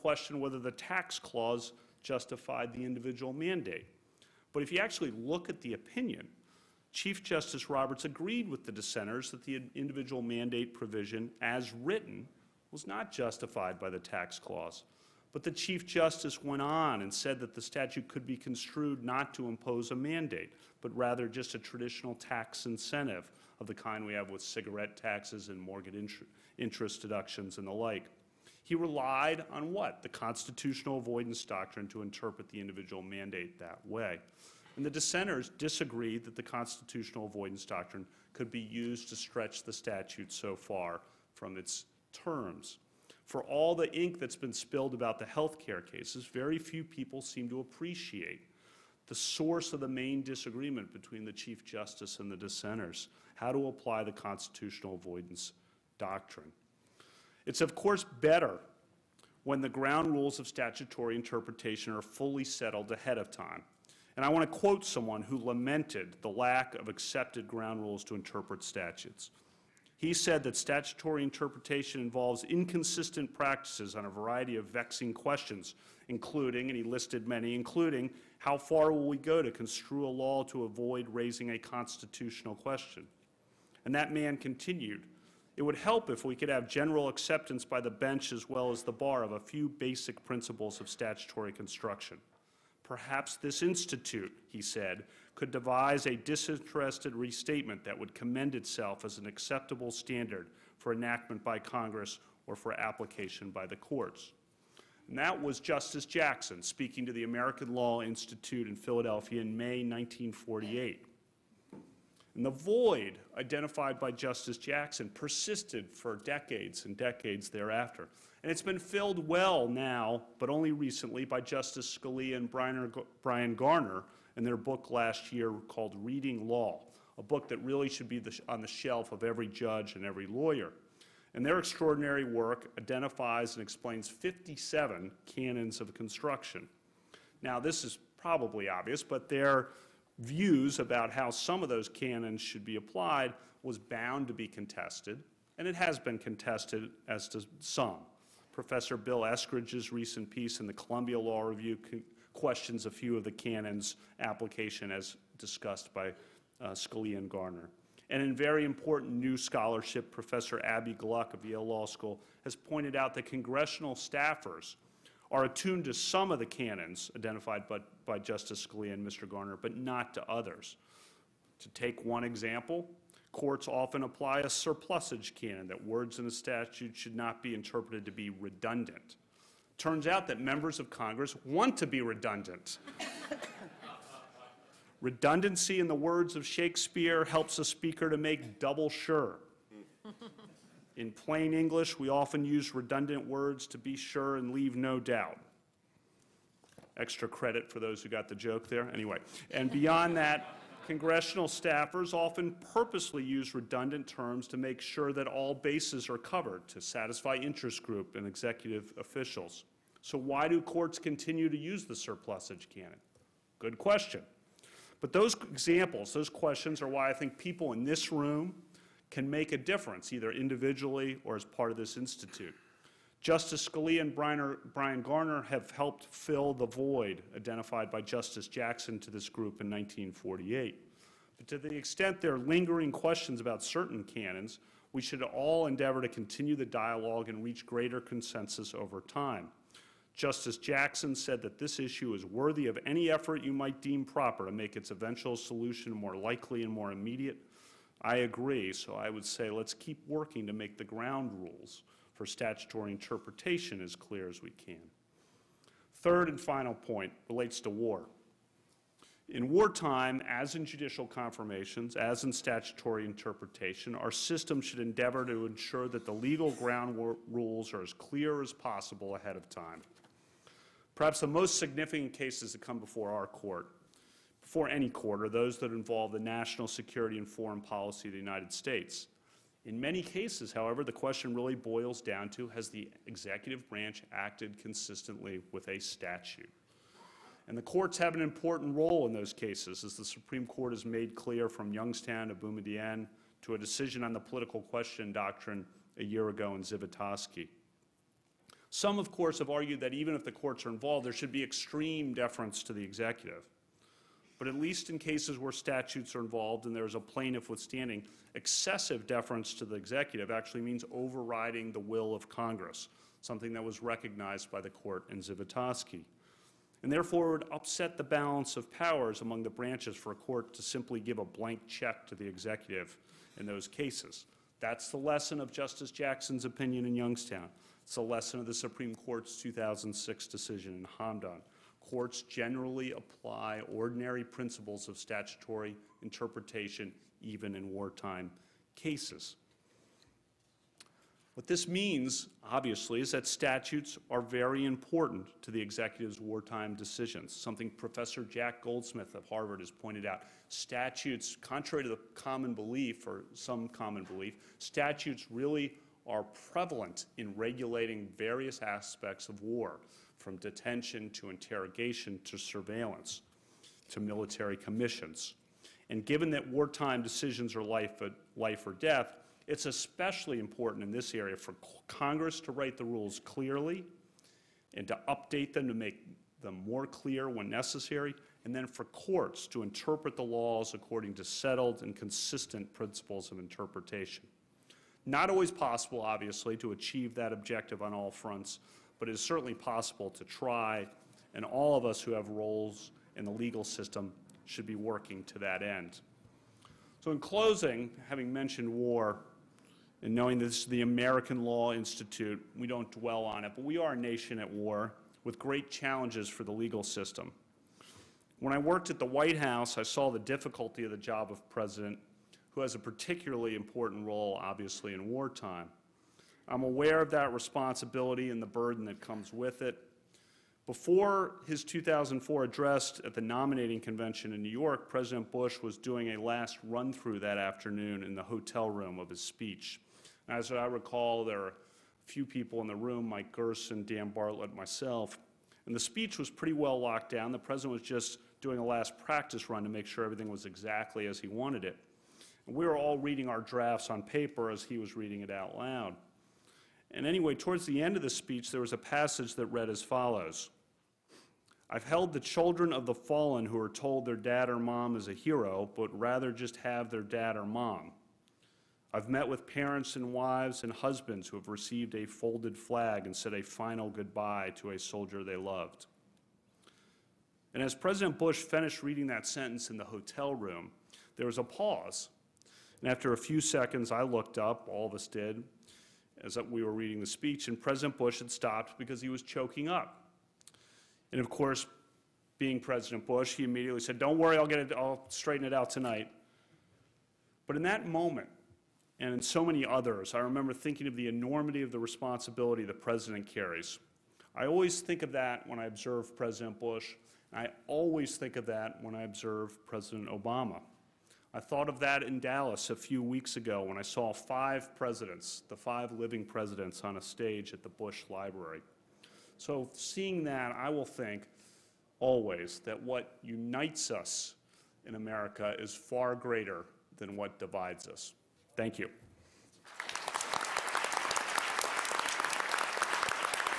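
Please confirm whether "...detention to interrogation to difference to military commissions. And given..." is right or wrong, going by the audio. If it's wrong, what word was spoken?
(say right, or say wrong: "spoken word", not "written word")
wrong: "surveillance", not "difference".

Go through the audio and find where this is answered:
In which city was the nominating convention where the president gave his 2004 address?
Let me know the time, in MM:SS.
07:04.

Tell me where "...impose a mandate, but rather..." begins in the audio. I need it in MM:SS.
00:19.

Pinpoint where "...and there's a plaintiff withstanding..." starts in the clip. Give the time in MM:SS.
05:06.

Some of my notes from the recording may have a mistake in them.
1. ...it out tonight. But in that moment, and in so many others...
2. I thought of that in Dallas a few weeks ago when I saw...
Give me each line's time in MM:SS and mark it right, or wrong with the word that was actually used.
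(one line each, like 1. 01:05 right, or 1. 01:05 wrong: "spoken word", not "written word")
1. 08:05 right
2. 08:21 right.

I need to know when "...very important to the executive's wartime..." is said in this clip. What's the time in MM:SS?
05:44.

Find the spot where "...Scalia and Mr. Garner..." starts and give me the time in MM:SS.
02:48.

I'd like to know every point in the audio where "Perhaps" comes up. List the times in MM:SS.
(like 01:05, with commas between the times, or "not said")
01:32, 04:30.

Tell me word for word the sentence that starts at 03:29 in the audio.
So why do courts continue to use the surplusage canon?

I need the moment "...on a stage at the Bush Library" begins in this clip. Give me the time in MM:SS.
08:26.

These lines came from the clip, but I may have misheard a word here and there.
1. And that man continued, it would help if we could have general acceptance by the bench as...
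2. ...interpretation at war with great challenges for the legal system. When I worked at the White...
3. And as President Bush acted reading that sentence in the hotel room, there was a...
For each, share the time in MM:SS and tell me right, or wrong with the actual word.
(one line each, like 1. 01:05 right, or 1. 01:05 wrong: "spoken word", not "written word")
1. 01:23 right
2. 06:43 wrong: "nation", not "interpretation"
3. 07:47 wrong: "finished", not "acted".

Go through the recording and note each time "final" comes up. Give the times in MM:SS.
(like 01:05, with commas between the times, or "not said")
04:16, 07:43.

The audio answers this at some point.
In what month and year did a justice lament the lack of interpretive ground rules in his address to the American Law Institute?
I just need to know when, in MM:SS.
01:49.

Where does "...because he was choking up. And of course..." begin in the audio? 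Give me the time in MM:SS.
07:58.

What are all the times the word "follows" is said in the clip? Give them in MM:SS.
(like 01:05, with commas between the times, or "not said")
07:29.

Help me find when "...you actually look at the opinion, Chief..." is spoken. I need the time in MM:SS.
00:04.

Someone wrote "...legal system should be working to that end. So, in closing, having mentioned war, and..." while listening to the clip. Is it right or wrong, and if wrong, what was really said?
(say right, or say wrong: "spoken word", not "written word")
right.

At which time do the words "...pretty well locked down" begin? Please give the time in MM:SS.
07:16.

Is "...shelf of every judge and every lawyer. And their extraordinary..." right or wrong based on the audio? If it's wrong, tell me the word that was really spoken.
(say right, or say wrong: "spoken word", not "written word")
right.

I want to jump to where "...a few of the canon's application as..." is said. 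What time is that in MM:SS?
02:32.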